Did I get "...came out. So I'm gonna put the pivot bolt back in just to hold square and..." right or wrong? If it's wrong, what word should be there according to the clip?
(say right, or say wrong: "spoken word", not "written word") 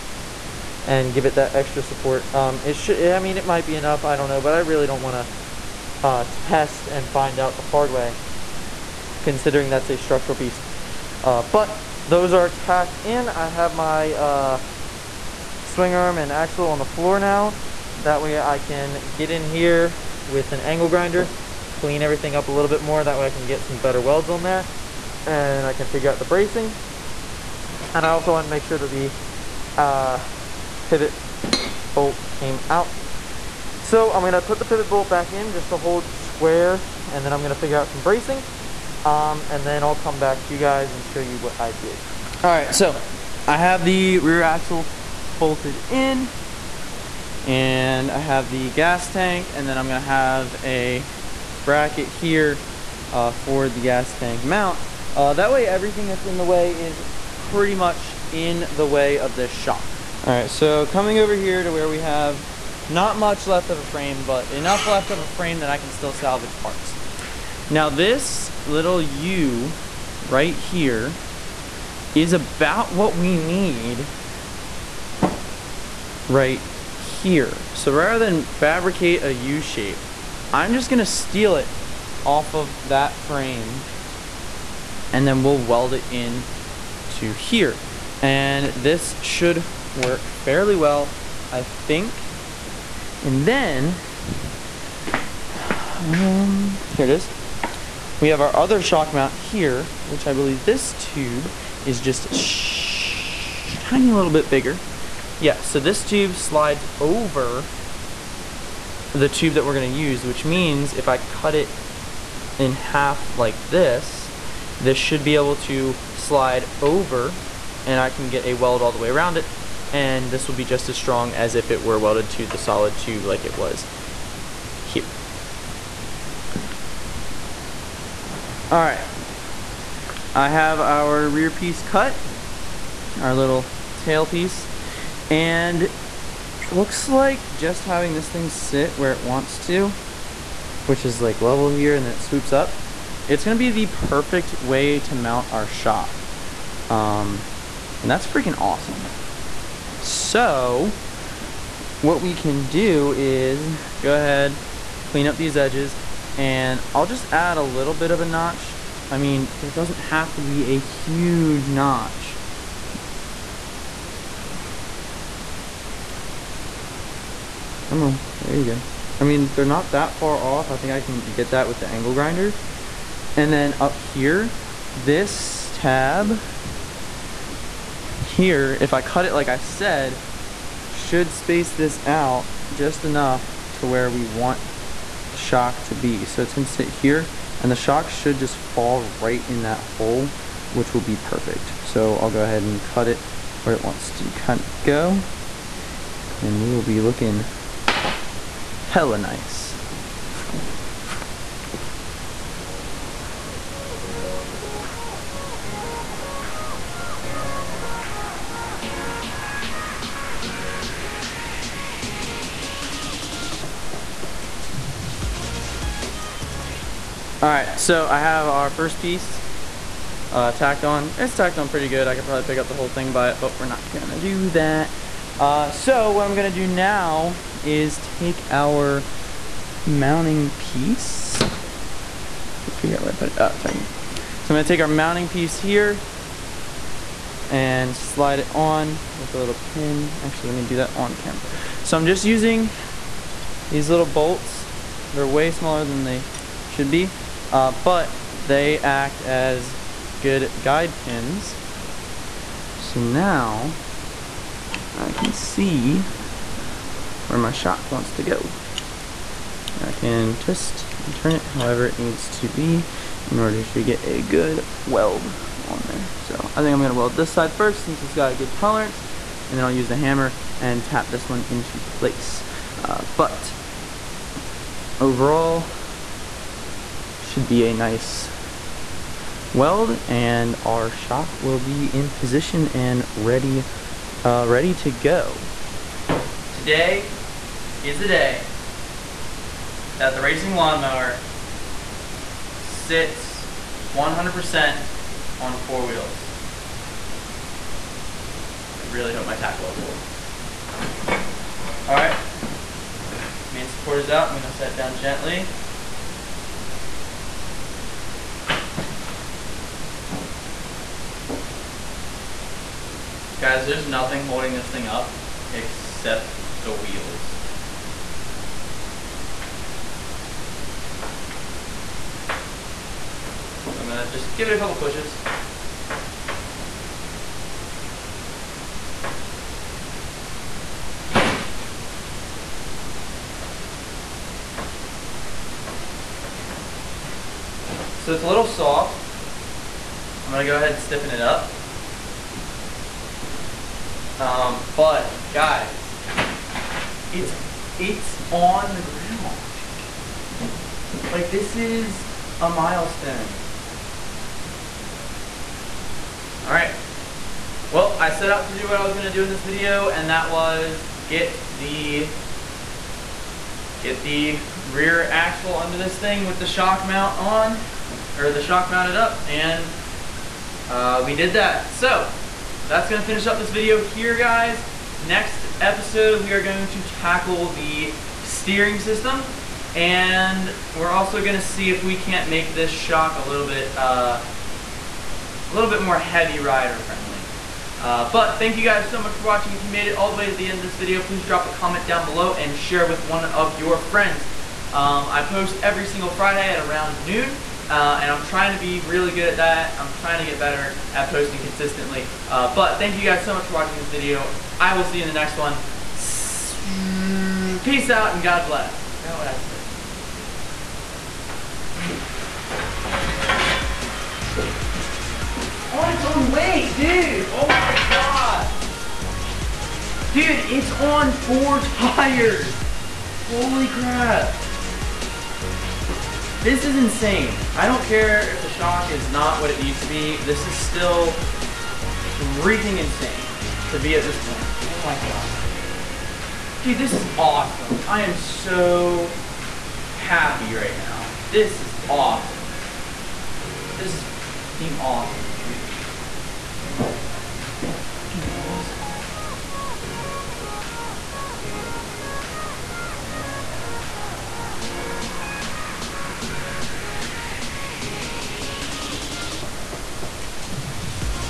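right.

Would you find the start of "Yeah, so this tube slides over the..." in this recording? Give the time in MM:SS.
01:45.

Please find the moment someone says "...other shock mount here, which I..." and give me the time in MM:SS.
01:38.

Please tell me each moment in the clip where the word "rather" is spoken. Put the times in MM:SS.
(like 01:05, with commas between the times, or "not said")
01:17.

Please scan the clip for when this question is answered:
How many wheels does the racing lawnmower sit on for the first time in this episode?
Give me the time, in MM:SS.
04:55.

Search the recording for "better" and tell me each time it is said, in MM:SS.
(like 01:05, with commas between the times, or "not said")
00:23, 06:40.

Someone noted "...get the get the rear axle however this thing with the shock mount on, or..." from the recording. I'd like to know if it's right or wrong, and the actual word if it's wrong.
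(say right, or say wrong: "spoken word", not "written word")
wrong: "under", not "however".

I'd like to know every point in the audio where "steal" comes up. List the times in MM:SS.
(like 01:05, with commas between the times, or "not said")
01:21.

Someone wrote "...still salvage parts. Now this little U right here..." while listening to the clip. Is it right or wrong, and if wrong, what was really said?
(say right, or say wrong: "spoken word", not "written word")
right.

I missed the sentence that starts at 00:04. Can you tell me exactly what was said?
I don't know, but I really don't want to uh, test and find out the hard way, considering that's a structural piece.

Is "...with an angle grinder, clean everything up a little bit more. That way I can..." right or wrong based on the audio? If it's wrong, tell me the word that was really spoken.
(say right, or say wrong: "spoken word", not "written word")
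right.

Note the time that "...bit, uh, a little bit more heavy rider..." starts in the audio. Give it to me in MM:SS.
06:23.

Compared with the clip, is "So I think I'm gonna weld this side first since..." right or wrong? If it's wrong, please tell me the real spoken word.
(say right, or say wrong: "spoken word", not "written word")
right.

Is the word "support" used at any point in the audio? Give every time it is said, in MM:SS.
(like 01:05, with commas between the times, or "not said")
00:01, 05:03.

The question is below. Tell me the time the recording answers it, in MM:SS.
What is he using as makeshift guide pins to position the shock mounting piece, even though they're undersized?
04:03.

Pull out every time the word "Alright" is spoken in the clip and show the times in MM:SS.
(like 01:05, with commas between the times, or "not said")
03:37, 05:56.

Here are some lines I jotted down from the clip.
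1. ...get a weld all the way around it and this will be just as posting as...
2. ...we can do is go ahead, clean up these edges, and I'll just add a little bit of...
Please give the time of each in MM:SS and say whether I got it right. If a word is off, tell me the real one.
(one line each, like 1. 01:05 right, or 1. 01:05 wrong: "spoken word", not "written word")
1. 01:58 wrong: "strong", not "posting"
2. 02:32 right.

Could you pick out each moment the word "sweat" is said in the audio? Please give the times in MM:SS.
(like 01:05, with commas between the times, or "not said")
not said.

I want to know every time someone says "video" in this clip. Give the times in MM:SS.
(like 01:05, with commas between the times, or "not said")
05:59, 06:13, 06:30, 06:43.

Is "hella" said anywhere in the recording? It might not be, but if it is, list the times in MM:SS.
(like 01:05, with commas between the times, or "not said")
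03:18.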